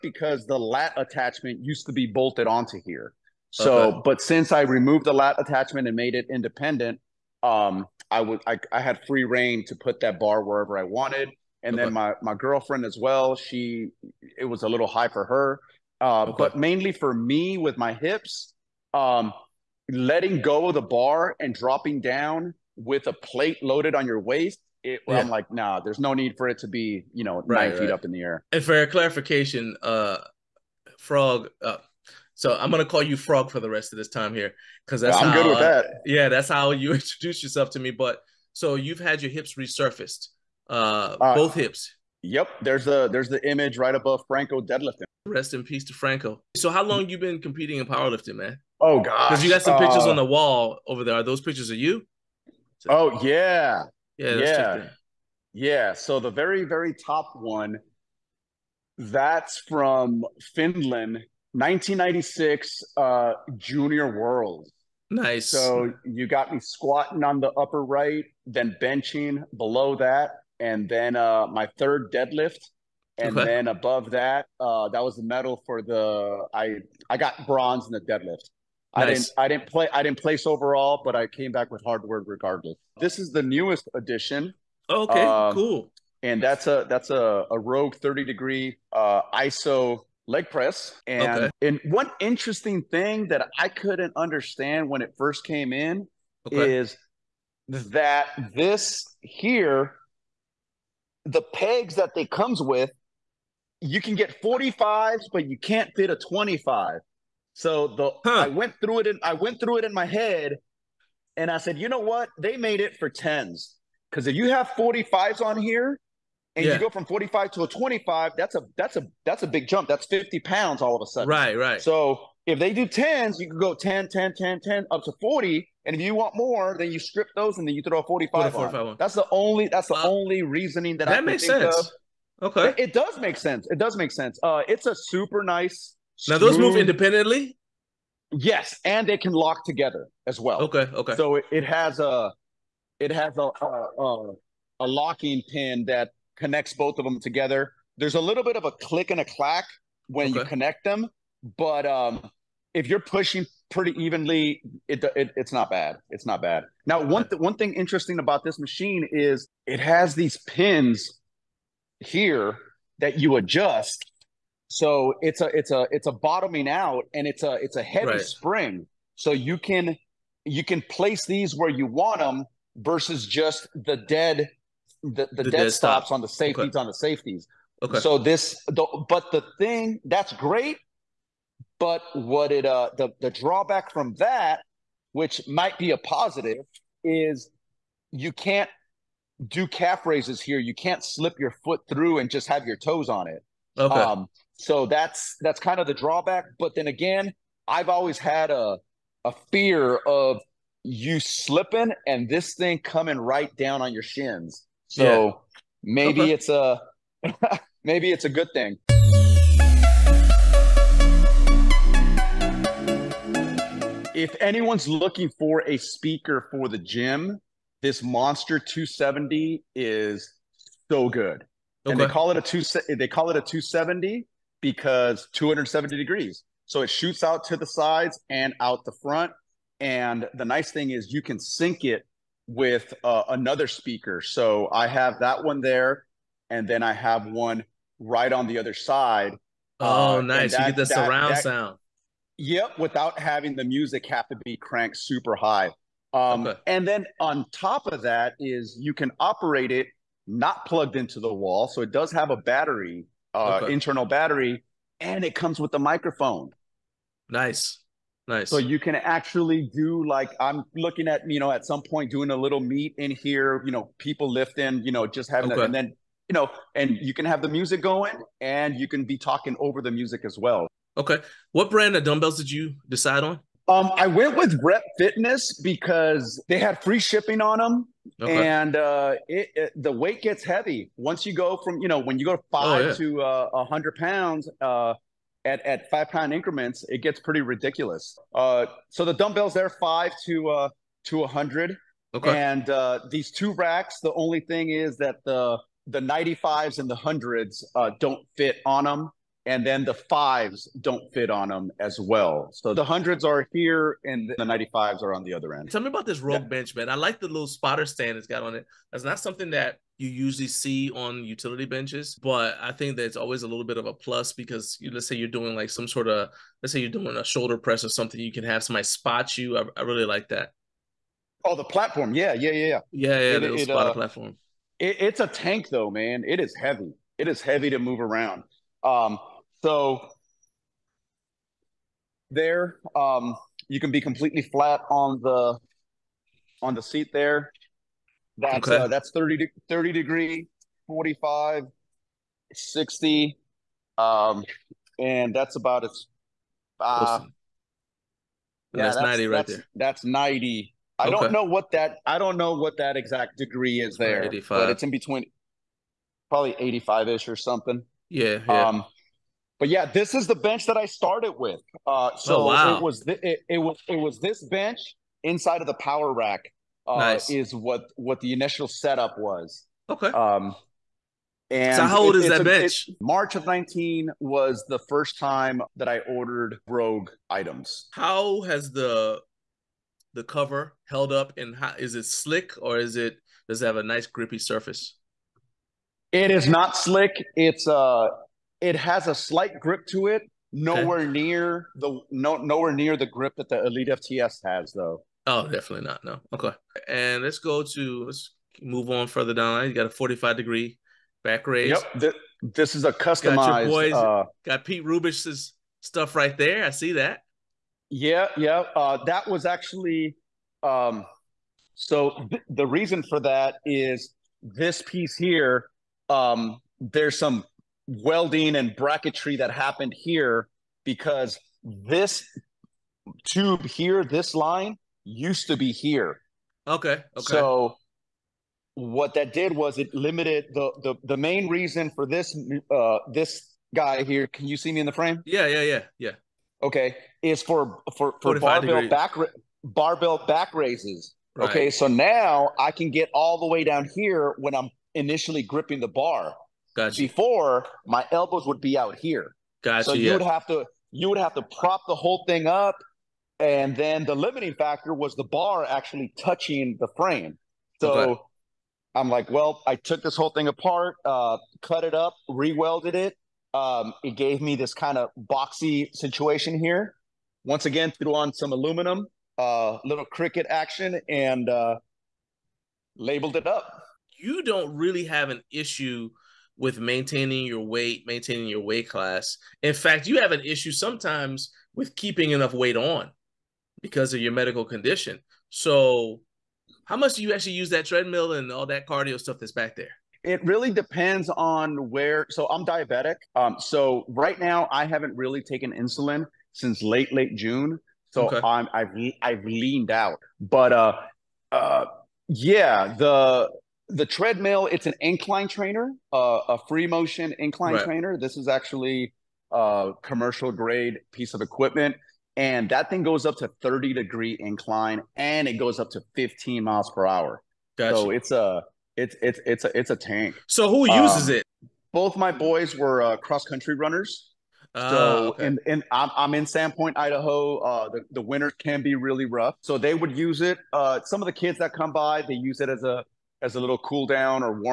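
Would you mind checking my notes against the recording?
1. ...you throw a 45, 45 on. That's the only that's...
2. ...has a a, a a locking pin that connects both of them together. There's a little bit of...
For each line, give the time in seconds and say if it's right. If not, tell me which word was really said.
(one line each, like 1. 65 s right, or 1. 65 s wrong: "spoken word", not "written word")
1. 127 s right
2. 143 s right.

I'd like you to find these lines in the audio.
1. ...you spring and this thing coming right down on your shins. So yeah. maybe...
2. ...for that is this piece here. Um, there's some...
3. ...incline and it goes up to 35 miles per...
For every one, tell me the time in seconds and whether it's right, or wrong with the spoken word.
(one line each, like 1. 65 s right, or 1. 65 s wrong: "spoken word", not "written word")
1. 200 s wrong: "slipping", not "spring"
2. 413 s right
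3. 514 s wrong: "15", not "35".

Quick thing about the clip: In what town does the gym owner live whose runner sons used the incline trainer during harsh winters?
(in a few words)
Sandpoint, Idaho.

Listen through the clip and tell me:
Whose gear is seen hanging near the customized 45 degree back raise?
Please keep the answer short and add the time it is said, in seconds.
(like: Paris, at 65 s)
Pete Rubish, at 404 s.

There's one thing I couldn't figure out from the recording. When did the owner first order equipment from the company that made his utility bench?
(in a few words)
March 2019.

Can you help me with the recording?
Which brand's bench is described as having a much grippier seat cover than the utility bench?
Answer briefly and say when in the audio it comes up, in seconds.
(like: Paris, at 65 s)
Elite FTS, at 393 s.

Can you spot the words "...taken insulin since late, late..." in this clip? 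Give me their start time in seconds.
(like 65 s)
495 s.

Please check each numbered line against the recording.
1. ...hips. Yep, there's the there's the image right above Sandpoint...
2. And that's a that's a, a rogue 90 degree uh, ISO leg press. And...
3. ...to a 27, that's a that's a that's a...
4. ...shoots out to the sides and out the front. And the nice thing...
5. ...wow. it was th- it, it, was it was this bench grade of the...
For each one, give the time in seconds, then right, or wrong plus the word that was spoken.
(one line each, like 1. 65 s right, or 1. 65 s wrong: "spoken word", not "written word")
1. 41 s wrong: "Franco", not "Sandpoint"
2. 86 s wrong: "30", not "90"
3. 117 s wrong: "25", not "27"
4. 226 s right
5. 362 s wrong: "inside", not "grade".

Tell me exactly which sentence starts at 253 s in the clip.
internal battery, and it comes with a microphone.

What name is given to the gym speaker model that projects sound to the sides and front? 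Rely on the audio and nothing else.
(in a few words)
Monster 270.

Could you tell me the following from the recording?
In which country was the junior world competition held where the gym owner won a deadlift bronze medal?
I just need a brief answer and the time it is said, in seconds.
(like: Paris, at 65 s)
Finland, at 60 s.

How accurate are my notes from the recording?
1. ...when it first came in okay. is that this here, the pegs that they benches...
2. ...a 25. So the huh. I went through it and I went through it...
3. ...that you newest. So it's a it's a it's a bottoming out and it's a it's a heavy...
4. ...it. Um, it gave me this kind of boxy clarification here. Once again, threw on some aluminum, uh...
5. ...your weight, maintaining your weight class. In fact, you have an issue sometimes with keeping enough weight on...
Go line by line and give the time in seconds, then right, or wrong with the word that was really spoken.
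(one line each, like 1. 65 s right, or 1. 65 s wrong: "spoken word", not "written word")
1. 94 s wrong: "comes", not "benches"
2. 106 s right
3. 162 s wrong: "adjust", not "newest"
4. 462 s wrong: "situation", not "clarification"
5. 477 s right.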